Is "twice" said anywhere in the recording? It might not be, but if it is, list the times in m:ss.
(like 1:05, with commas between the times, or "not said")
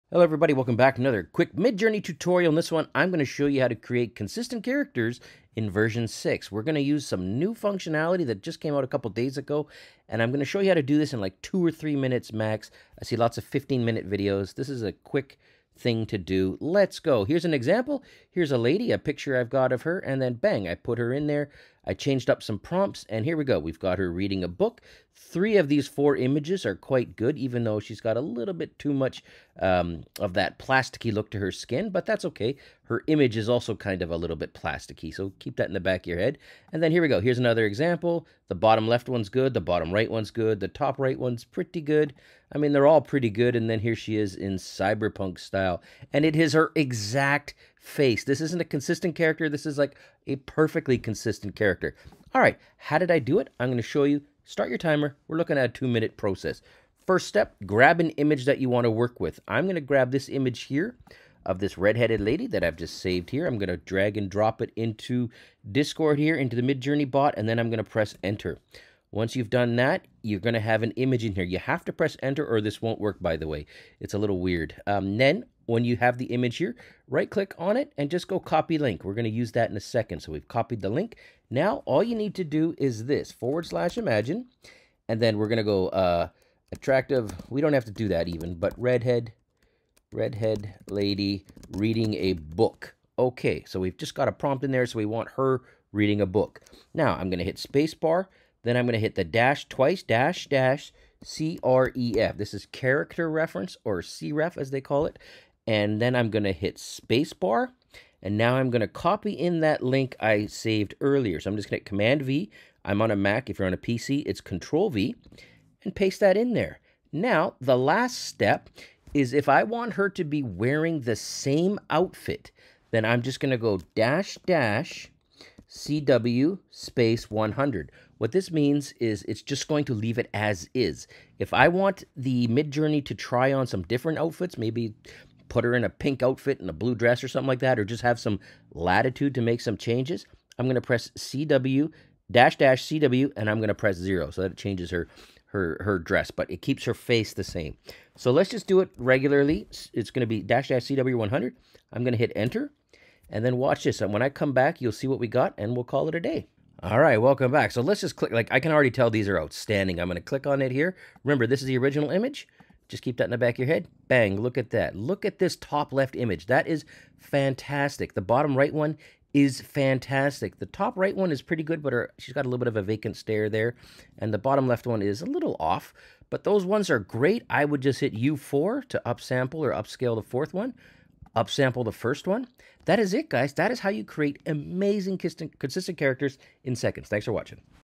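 1:39.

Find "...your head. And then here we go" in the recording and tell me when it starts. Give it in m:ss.
0:36.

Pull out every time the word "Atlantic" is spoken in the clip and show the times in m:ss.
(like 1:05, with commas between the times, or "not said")
not said.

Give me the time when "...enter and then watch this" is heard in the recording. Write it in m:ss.
2:32.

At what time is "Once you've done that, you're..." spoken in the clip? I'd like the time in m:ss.
1:09.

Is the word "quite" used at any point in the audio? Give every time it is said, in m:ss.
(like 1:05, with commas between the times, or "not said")
0:26.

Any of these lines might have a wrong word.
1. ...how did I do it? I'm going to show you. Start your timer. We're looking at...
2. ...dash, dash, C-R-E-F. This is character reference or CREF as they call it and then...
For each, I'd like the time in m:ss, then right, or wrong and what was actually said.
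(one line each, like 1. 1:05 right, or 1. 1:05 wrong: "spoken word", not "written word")
1. 0:52 right
2. 1:40 right.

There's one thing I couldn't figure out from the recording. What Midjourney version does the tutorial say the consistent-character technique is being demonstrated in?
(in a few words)
version 6.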